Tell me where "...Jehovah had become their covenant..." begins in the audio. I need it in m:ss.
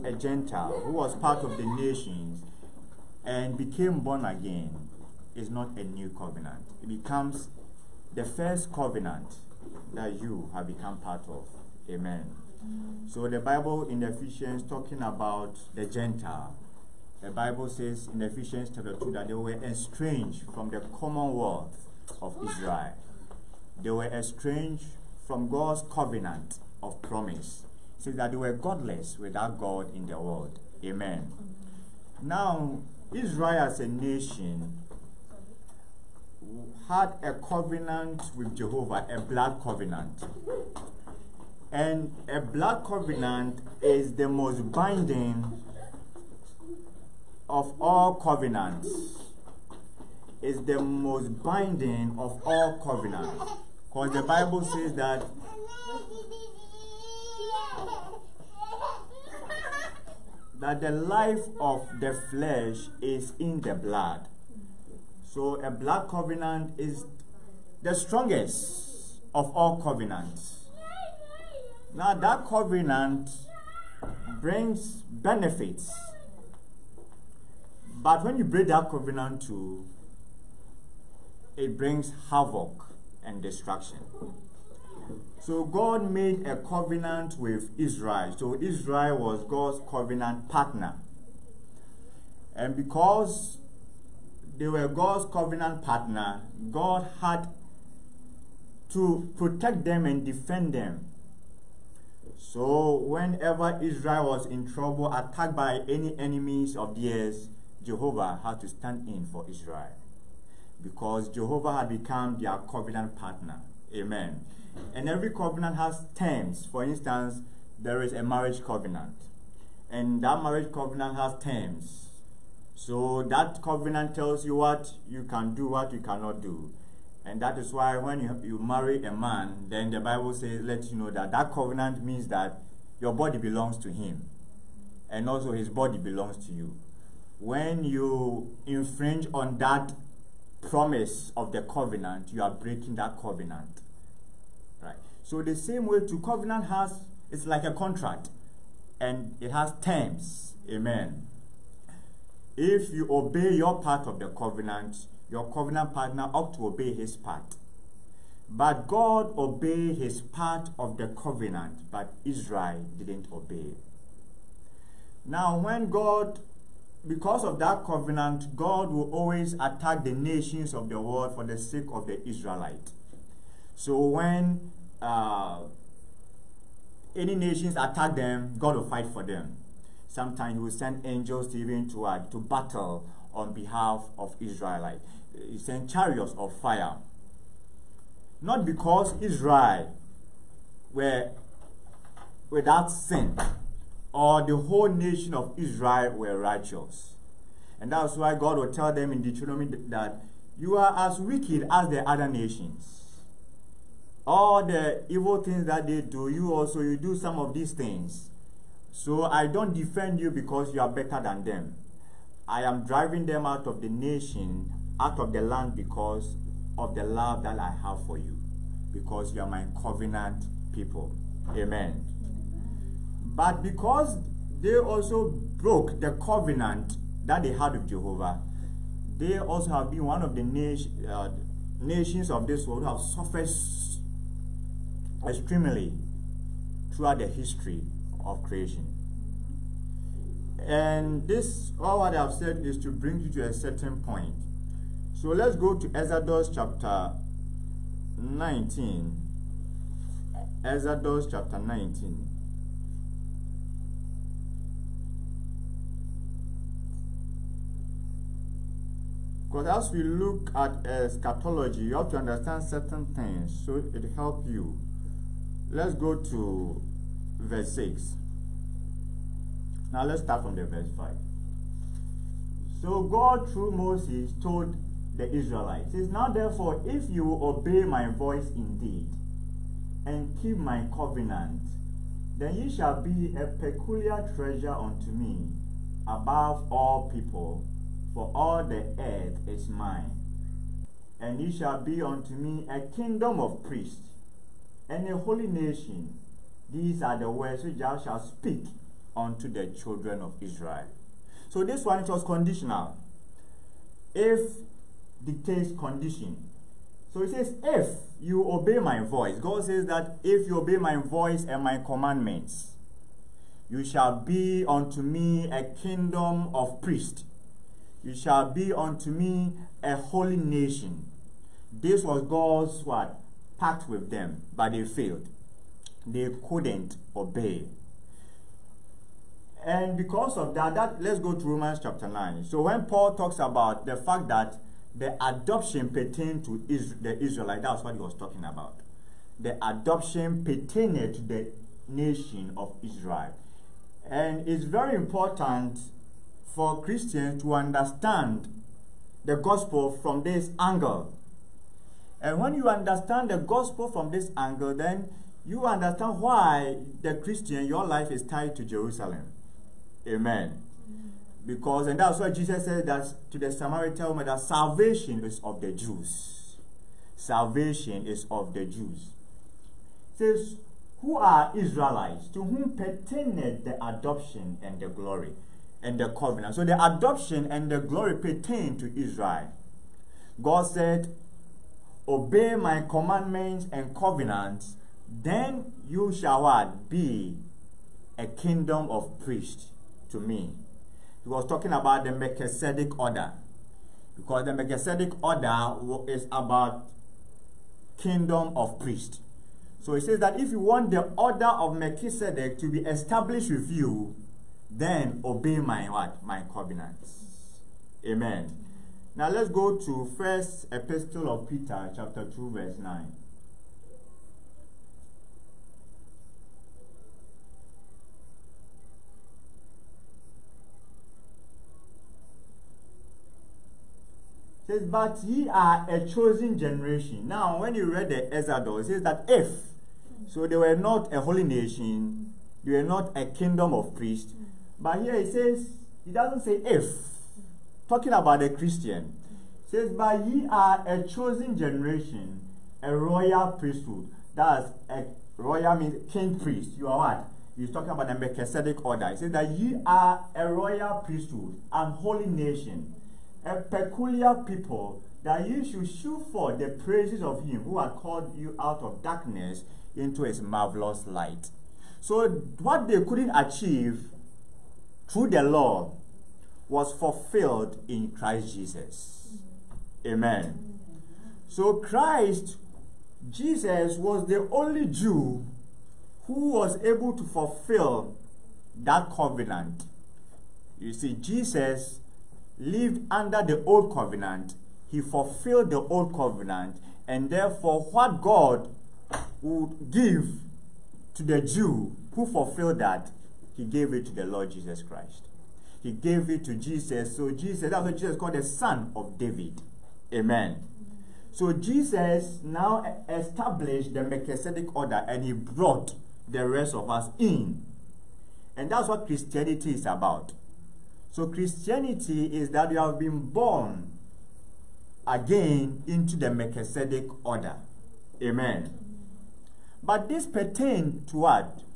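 1:51.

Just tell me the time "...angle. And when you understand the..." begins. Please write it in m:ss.
5:50.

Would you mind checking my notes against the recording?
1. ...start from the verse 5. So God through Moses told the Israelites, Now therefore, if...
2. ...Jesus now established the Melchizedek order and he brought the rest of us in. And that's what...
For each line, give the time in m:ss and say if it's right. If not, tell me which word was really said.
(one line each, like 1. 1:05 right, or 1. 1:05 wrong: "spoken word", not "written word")
1. 4:30 right
2. 8:21 right.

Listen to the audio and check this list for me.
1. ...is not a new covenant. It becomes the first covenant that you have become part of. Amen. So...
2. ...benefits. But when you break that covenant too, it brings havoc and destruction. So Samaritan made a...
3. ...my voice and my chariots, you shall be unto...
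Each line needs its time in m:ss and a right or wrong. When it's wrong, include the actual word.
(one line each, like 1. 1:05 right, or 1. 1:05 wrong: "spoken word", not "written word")
1. 0:05 right
2. 1:15 wrong: "God", not "Samaritan"
3. 5:10 wrong: "commandments", not "chariots".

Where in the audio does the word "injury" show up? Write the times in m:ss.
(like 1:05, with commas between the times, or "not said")
not said.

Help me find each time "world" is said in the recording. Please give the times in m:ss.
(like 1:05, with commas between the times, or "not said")
0:30, 2:50, 3:52.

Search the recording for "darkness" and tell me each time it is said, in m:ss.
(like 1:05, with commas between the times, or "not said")
7:39.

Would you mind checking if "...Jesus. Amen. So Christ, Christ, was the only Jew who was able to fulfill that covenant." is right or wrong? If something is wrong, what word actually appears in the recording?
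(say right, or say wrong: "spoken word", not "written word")
wrong: "Jesus", not "Christ".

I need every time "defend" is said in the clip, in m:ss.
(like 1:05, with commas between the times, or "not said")
1:40, 3:29.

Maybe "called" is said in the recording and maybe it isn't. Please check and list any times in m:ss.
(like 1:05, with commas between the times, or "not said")
7:37, 8:18.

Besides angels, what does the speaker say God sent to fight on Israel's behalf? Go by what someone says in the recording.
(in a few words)
Chariots of fire.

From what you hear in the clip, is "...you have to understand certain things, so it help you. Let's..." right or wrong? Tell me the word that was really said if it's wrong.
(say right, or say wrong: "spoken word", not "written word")
right.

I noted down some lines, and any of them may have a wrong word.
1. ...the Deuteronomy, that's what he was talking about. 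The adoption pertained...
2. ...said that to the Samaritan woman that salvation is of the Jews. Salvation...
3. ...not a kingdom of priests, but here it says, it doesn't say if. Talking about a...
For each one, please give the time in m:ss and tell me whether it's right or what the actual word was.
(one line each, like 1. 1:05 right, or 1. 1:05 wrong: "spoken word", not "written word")
1. 5:37 wrong: "Israelite", not "Deuteronomy"
2. 6:02 right
3. 7:12 right.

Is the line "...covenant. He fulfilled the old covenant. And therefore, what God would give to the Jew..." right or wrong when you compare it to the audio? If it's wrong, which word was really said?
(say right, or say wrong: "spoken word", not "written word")
right.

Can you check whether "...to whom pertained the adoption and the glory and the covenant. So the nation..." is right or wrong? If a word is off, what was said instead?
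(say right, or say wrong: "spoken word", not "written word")
wrong: "adoption", not "nation".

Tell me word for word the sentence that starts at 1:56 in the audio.
For instance, there is a marriage covenant.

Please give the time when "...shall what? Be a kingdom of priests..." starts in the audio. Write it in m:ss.
6:26.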